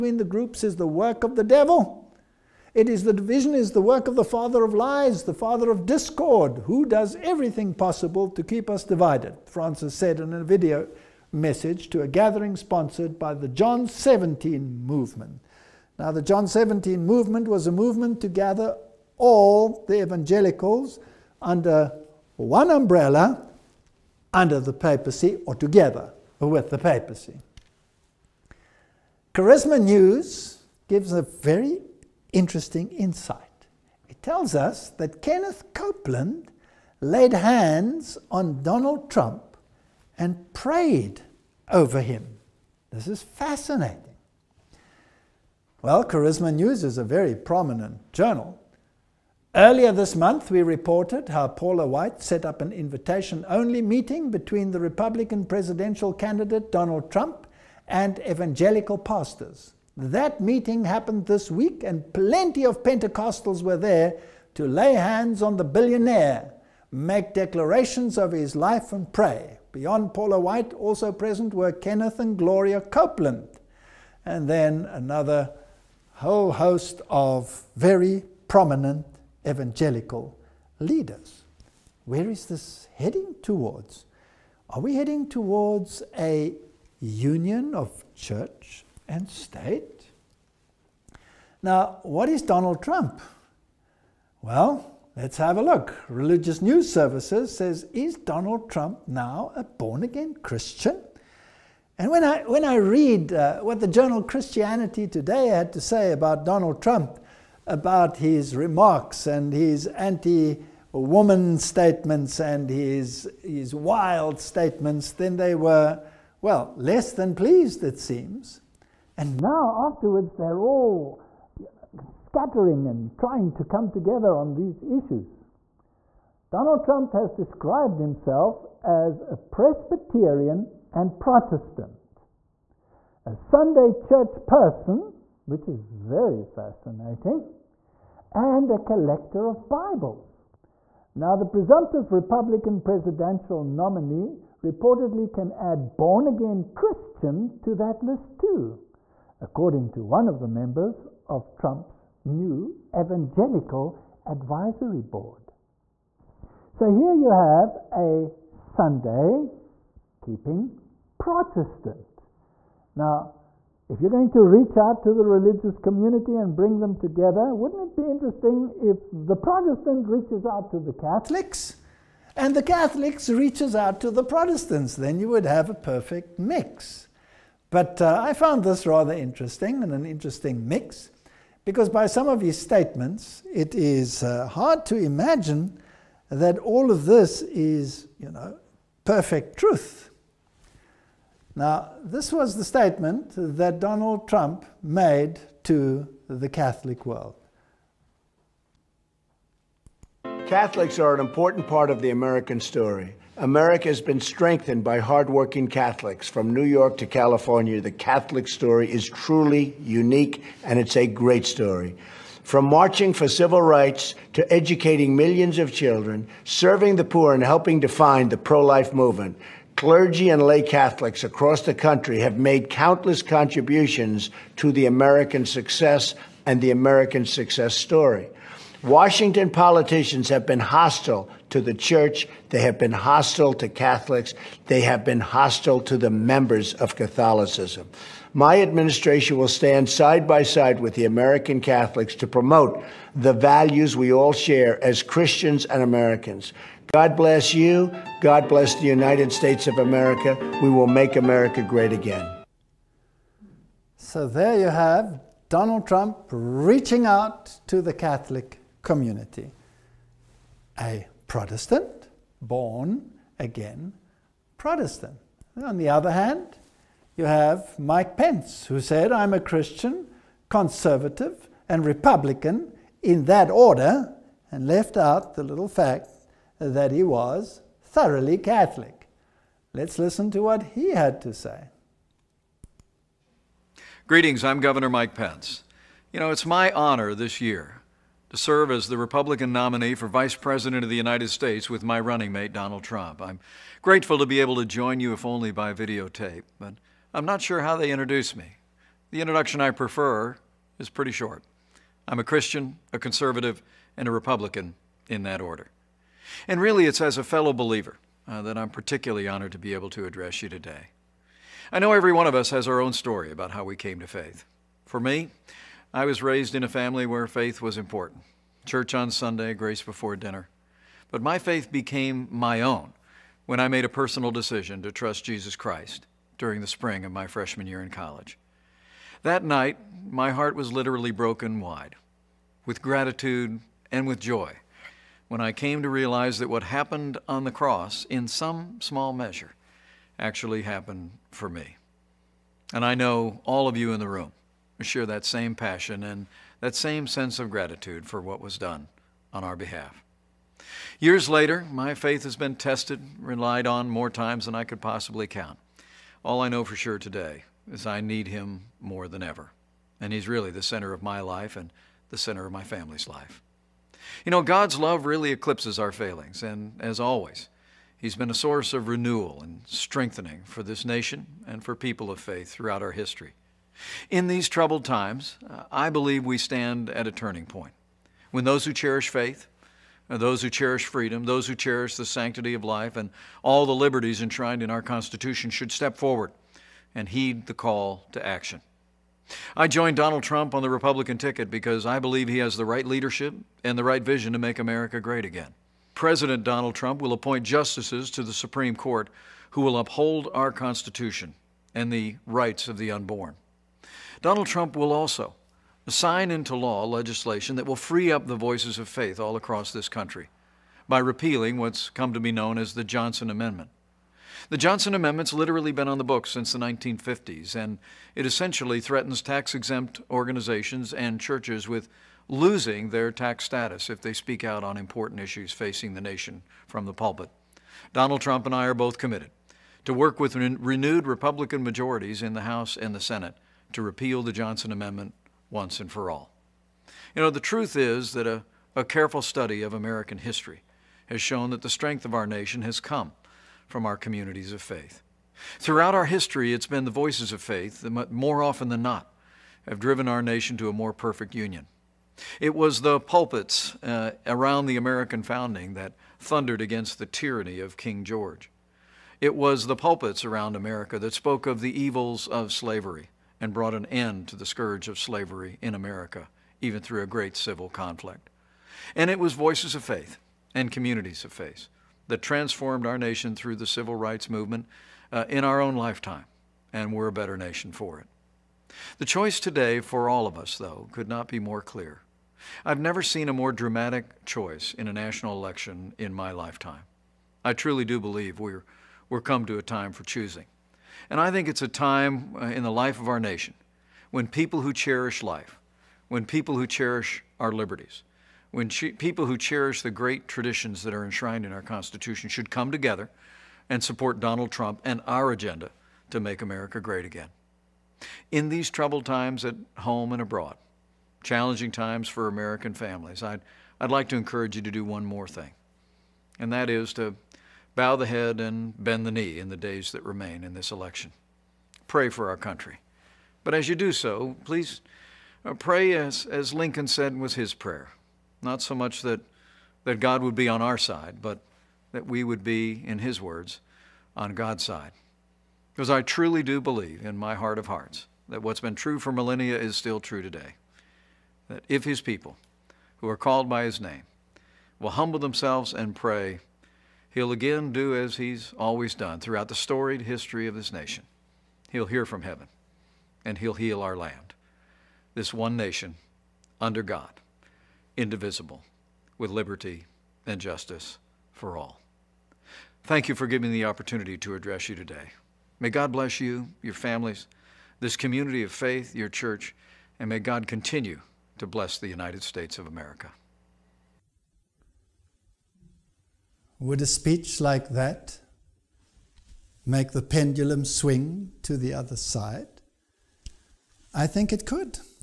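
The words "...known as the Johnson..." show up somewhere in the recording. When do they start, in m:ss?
6:52.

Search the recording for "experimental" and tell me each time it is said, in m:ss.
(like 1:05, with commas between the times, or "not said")
not said.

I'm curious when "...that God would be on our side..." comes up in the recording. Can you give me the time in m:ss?
8:49.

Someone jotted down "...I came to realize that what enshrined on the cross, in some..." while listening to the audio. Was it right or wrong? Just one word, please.
wrong.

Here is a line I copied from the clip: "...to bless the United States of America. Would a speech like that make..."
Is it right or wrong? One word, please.
right.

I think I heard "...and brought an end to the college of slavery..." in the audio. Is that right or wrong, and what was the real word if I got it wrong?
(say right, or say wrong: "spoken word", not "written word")
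wrong: "scourge", not "college".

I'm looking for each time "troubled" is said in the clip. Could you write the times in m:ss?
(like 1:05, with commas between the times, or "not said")
6:14, 8:28.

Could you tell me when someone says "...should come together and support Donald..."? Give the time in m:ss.
8:22.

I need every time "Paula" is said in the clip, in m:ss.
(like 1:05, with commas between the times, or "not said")
0:51, 1:10.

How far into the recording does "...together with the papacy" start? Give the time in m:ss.
0:25.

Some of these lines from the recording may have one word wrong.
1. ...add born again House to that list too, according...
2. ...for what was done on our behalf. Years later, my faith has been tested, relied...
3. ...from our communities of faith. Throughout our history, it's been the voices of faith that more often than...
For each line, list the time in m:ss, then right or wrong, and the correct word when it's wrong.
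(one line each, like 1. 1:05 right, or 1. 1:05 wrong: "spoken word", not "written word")
1. 2:25 wrong: "Christian", not "House"
2. 5:48 right
3. 7:23 right.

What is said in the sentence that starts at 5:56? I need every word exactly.
All I know for sure today is I need him more than ever.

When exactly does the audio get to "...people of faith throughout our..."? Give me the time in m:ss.
6:11.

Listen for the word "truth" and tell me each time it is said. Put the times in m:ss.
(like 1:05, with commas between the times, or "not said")
3:09, 7:17.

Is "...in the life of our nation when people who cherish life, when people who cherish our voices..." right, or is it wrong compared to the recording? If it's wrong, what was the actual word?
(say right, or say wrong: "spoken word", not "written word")
wrong: "liberties", not "voices".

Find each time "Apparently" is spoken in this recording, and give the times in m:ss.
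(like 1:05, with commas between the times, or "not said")
not said.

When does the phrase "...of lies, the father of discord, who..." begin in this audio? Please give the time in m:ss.
0:04.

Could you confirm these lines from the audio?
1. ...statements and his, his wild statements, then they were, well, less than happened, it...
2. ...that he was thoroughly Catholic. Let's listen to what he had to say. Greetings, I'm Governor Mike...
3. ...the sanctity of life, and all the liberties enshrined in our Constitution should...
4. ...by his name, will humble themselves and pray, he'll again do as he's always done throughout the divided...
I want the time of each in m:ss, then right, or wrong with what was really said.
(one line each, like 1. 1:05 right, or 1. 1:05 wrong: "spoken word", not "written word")
1. 1:51 wrong: "pleased", not "happened"
2. 4:36 right
3. 6:21 right
4. 9:03 wrong: "storied", not "divided".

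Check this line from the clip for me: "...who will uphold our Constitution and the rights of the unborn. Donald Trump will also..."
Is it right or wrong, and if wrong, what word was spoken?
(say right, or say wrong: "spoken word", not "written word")
right.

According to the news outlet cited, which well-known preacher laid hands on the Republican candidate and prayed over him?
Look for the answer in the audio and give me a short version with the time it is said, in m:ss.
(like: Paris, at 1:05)
Kenneth Copeland, at 0:35.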